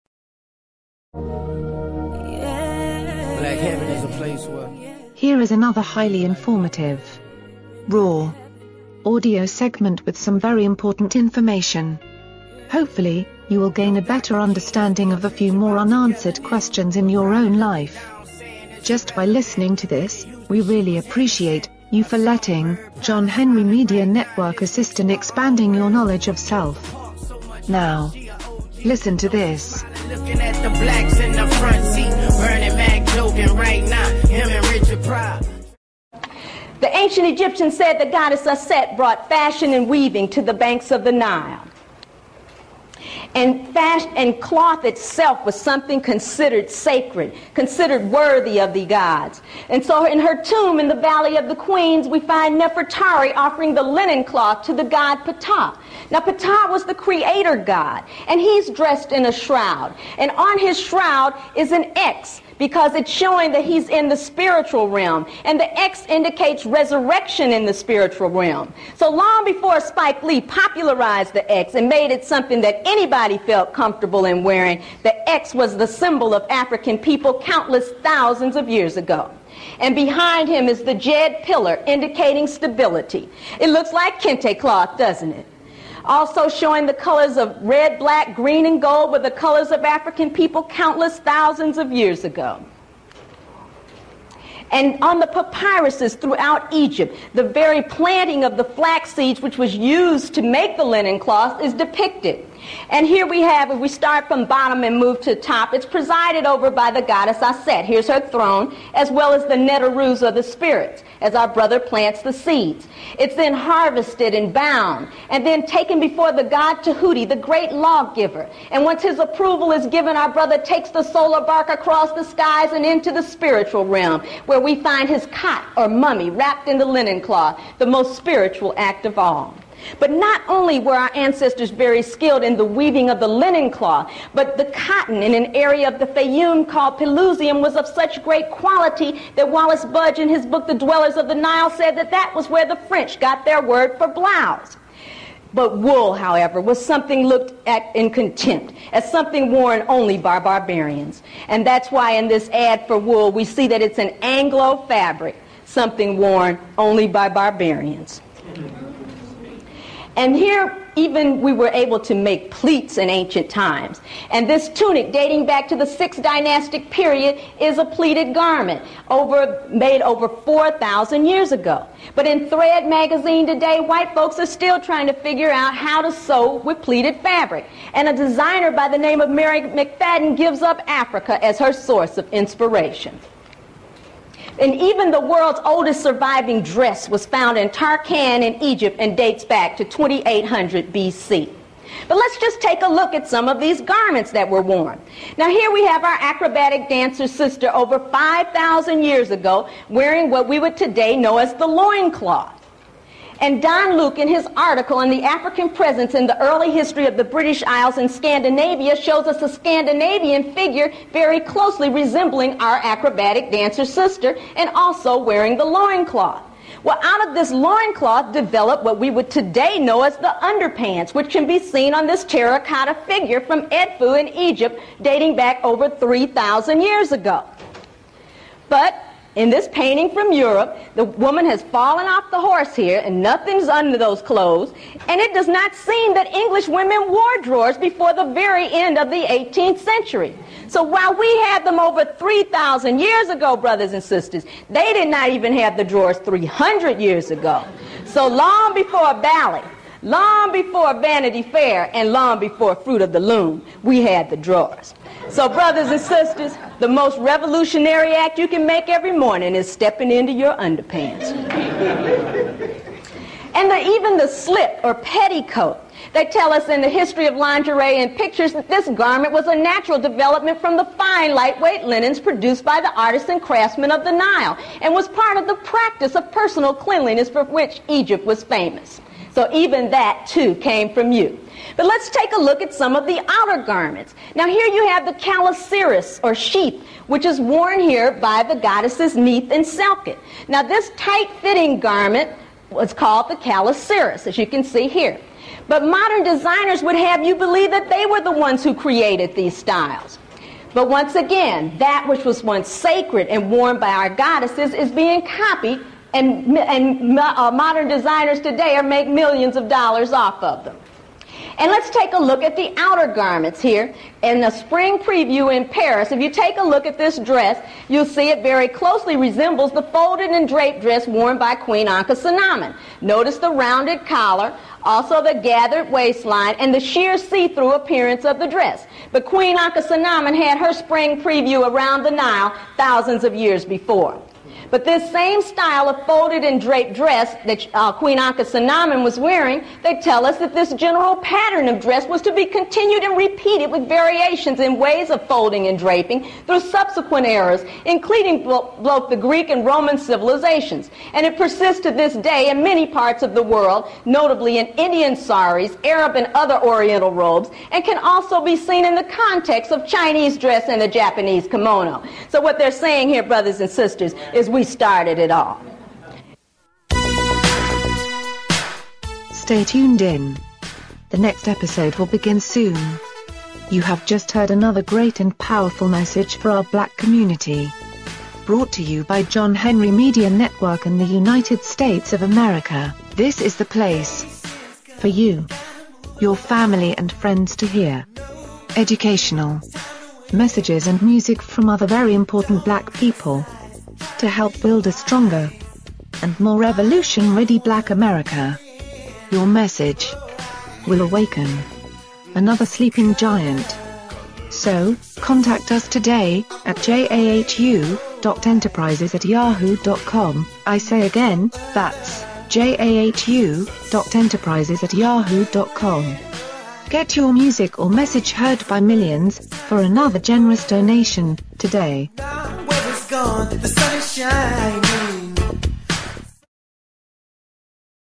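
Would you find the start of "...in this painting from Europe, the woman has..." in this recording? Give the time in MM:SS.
03:49.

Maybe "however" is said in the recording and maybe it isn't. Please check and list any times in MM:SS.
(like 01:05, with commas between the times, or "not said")
02:26.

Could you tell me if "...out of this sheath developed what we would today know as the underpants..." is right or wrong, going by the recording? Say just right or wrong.
wrong.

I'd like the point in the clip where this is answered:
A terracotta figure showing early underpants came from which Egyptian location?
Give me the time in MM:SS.
03:43.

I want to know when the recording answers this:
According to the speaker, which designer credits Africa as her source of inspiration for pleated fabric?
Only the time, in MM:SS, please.
02:59.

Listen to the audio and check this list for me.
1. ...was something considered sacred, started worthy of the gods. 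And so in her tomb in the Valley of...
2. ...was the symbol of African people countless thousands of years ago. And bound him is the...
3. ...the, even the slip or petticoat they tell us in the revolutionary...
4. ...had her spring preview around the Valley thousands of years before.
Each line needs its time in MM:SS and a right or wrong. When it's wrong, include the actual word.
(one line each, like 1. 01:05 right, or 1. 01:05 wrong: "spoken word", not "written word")
1. 00:45 wrong: "considered", not "started"
2. 01:15 wrong: "behind", not "bound"
3. 04:23 wrong: "history", not "revolutionary"
4. 05:30 wrong: "Nile", not "Valley".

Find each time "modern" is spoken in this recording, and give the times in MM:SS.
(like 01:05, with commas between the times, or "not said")
04:55, 05:07.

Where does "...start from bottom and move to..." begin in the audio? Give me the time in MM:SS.
01:43.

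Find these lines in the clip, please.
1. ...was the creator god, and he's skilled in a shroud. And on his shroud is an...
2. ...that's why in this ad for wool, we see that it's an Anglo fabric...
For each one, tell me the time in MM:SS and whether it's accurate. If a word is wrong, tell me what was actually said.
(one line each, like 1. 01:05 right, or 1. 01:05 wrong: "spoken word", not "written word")
1. 00:56 wrong: "dressed", not "skilled"
2. 02:31 right.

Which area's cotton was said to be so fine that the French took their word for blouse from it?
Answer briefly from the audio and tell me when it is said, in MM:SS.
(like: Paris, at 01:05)
Pelusium, at 02:16.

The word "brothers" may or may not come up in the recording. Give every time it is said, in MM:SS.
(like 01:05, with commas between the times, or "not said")
01:51, 02:00, 04:03, 04:15, 06:03.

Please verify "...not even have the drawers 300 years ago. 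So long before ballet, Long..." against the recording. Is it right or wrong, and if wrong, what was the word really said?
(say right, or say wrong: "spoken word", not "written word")
right.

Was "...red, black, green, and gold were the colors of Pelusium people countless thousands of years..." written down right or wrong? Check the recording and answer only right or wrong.
wrong.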